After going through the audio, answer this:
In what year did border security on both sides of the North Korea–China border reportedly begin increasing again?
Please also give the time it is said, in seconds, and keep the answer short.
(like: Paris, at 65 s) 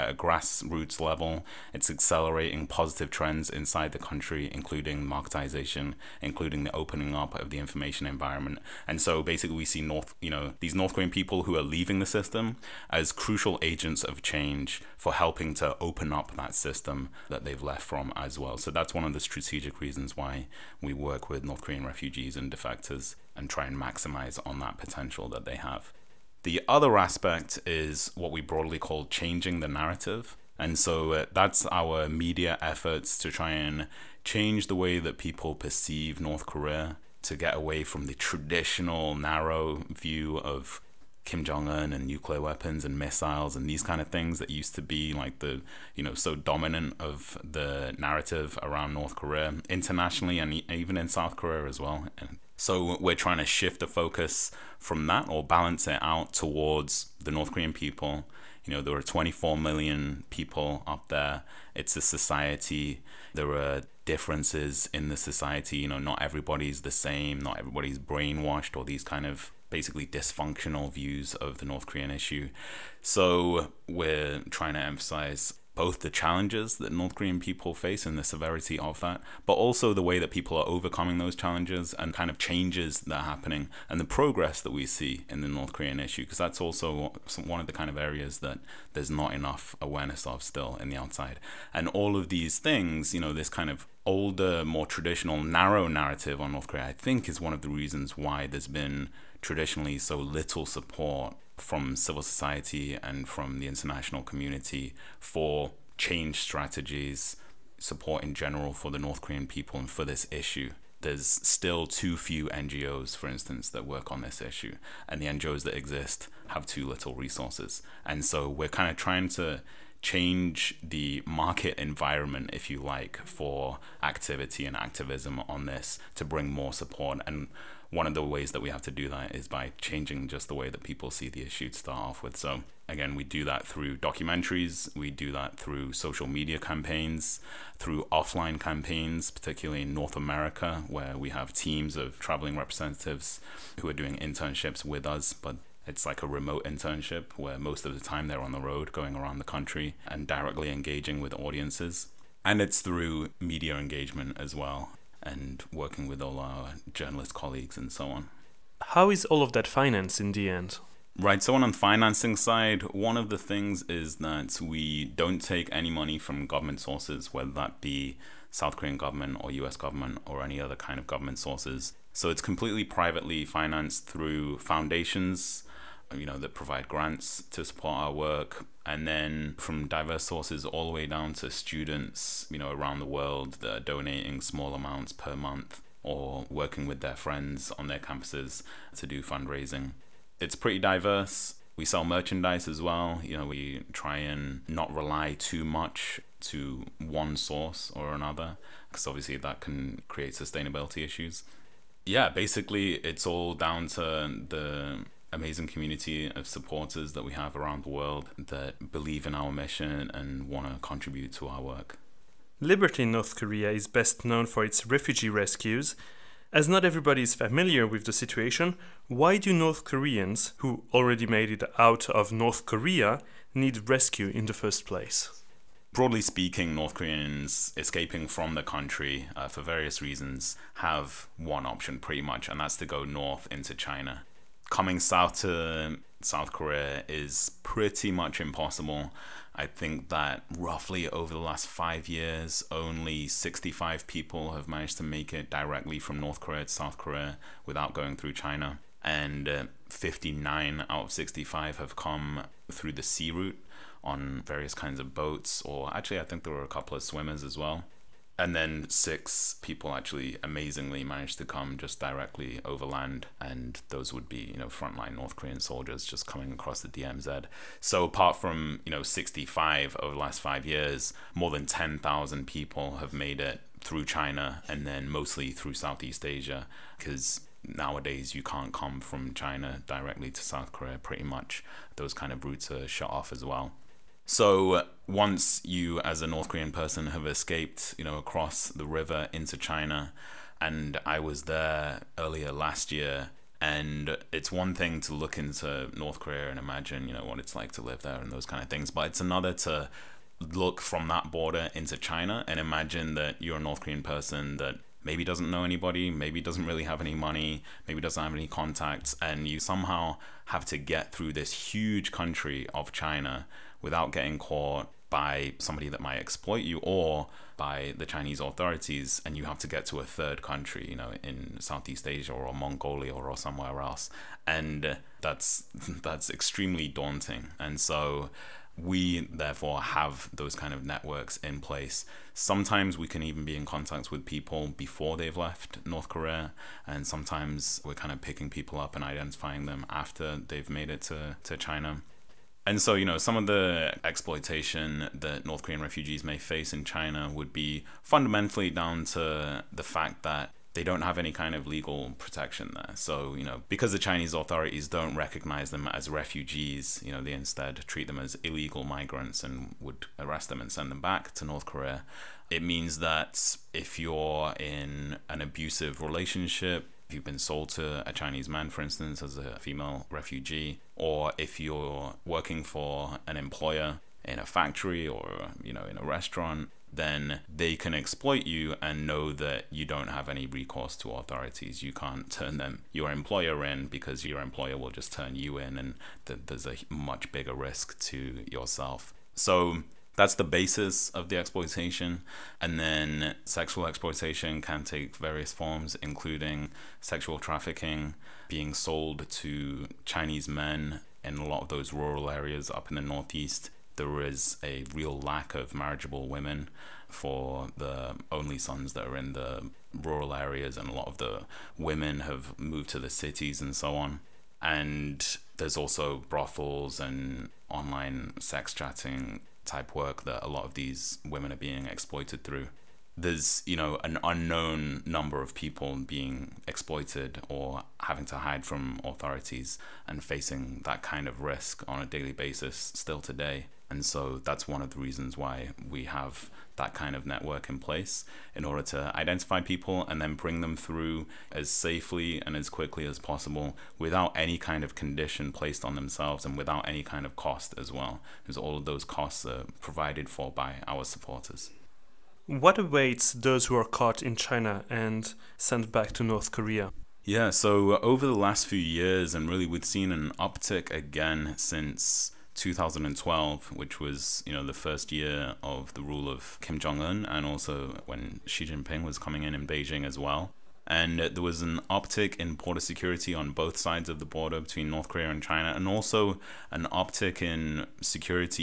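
2012, at 462 s.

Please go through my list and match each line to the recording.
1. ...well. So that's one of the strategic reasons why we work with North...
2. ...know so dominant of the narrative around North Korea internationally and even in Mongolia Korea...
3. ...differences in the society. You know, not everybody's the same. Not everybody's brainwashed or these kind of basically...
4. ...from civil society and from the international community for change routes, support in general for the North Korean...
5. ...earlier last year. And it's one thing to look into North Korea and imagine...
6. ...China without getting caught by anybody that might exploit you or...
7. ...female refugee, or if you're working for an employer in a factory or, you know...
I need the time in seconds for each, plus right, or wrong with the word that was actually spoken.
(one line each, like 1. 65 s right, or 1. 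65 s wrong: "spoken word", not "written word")
1. 18 s right
2. 46 s wrong: "South", not "Mongolia"
3. 64 s right
4. 101 s wrong: "strategies", not "routes"
5. 292 s right
6. 312 s wrong: "somebody", not "anybody"
7. 369 s right.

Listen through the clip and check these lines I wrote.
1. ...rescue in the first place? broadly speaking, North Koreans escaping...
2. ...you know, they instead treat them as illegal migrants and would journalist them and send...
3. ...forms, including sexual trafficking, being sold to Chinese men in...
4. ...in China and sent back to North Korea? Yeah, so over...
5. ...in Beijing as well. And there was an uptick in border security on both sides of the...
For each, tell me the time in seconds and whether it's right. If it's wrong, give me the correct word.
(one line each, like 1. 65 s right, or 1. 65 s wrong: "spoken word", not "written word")
1. 223 s right
2. 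357 s wrong: "arrest", not "journalist"
3. 395 s right
4. 454 s right
5. 469 s right.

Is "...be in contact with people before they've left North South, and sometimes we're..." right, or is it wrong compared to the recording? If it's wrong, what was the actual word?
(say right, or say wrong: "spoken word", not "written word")
wrong: "Korea", not "South".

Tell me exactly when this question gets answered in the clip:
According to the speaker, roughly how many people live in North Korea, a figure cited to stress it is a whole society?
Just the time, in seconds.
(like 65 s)
59 s.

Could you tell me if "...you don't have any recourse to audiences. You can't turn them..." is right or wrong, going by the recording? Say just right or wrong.
wrong.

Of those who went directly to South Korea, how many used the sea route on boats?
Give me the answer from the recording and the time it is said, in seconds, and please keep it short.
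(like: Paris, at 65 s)
59, at 249 s.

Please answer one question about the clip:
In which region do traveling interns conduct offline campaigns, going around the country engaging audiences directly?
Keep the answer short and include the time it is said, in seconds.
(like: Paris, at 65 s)
North America, at 139 s.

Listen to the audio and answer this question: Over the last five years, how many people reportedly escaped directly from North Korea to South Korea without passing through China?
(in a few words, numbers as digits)
65.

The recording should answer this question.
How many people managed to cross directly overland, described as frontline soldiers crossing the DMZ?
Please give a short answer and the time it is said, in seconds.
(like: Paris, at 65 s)
6, at 258 s.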